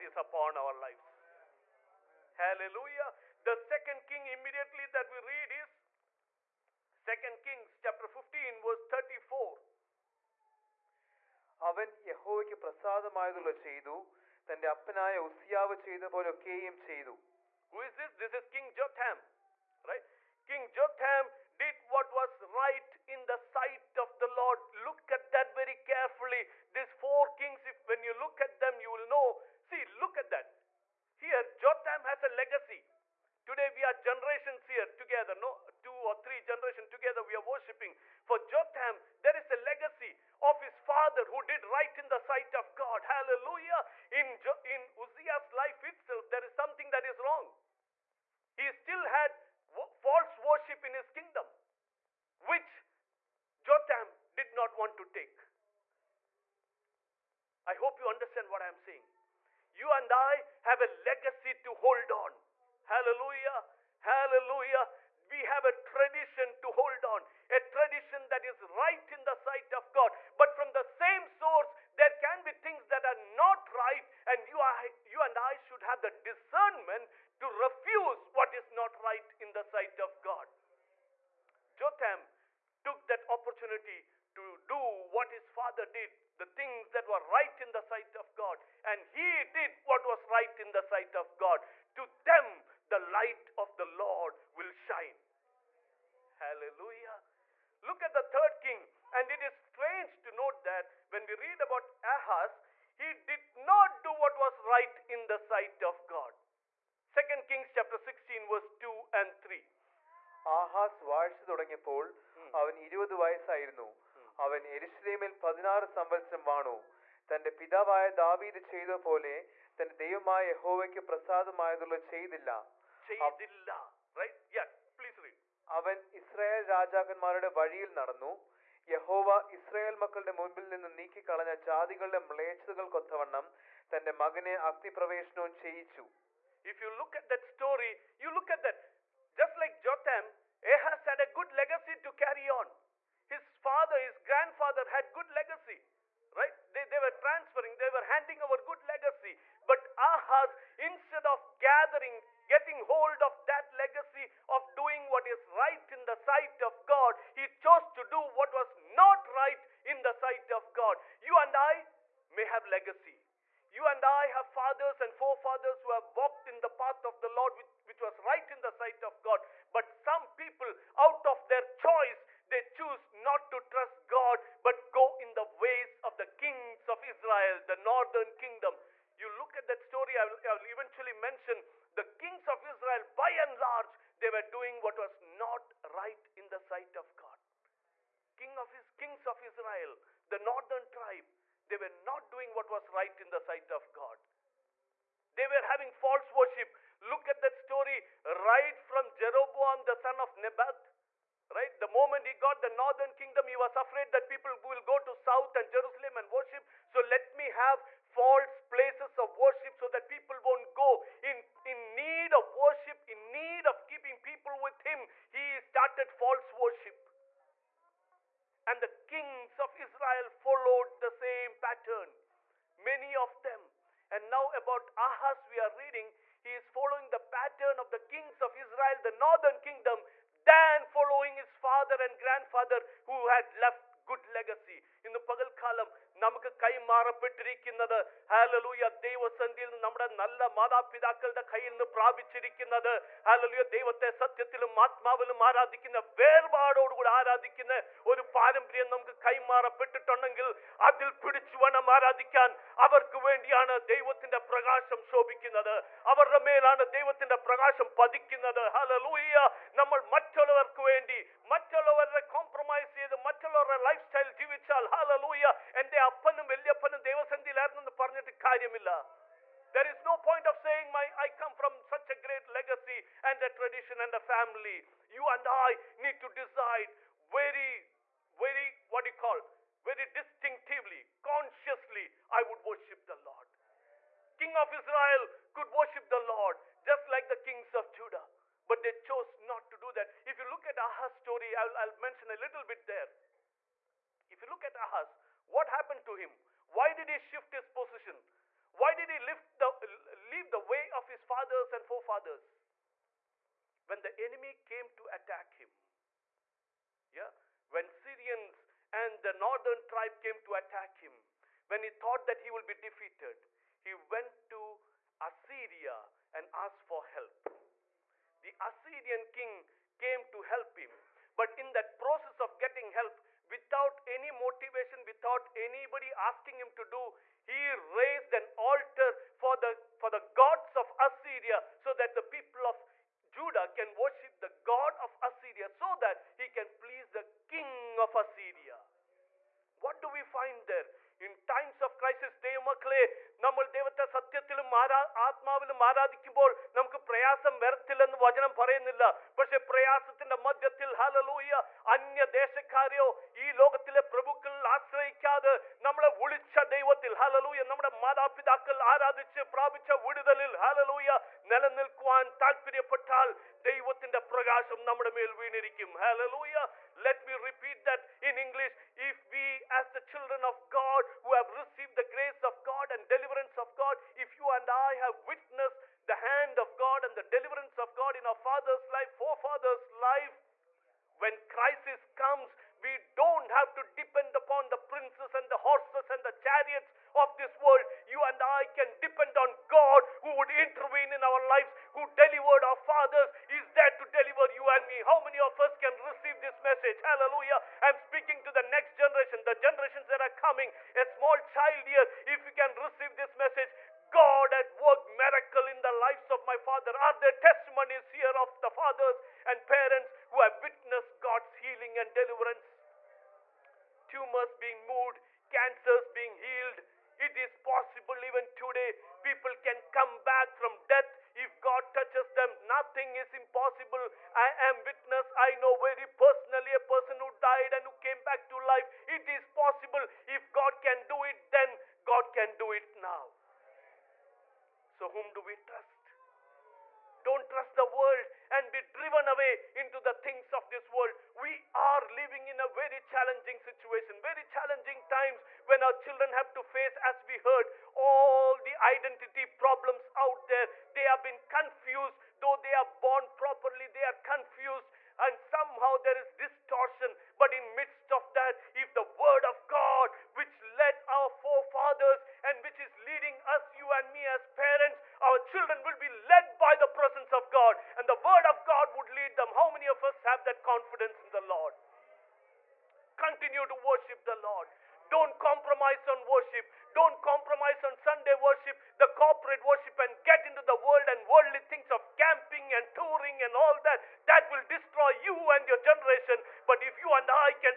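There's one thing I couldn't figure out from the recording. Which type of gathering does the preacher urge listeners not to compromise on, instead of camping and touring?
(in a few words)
Sunday worship.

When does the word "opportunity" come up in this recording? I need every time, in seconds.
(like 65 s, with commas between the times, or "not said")
83 s.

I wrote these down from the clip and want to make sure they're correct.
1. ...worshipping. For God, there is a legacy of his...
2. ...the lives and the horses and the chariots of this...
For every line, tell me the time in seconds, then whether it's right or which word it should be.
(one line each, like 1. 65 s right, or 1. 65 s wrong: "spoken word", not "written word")
1. 37 s wrong: "Jotham", not "God"
2. 384 s wrong: "princes", not "lives".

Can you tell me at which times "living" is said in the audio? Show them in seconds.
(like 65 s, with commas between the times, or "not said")
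442 s.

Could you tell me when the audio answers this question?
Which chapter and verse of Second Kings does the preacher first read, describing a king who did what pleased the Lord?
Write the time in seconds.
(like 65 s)
7 s.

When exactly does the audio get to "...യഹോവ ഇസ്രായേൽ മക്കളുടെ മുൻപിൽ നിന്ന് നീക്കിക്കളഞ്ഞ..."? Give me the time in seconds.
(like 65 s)
128 s.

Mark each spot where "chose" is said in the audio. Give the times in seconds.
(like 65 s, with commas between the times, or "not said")
157 s, 289 s.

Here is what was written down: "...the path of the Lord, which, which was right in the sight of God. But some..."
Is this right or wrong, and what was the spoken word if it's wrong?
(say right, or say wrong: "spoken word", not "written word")
right.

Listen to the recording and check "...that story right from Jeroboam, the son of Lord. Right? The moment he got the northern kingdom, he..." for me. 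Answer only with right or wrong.
wrong.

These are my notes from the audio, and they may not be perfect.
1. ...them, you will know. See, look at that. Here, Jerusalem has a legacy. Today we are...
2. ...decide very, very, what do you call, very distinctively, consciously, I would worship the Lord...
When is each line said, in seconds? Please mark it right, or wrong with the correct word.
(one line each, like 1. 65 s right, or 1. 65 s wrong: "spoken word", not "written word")
1. 28 s wrong: "Jotham", not "Jerusalem"
2. 276 s right.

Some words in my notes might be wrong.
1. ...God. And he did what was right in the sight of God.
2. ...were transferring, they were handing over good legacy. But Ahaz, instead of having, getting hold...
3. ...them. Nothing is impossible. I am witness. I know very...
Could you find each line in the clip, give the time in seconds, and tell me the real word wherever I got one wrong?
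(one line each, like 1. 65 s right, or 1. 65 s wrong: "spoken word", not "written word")
1. 88 s right
2. 146 s wrong: "gathering", not "having"
3. 422 s right.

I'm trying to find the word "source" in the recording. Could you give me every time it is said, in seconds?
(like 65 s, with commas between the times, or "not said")
71 s.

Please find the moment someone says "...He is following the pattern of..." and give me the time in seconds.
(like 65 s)
226 s.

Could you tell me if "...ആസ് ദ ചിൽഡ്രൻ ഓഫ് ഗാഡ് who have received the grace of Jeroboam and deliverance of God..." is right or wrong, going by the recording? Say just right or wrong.
wrong.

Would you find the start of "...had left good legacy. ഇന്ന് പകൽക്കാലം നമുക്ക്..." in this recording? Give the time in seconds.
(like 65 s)
233 s.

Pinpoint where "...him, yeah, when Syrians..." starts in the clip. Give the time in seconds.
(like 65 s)
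305 s.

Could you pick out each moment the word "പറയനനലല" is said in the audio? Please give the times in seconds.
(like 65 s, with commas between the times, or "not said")
348 s.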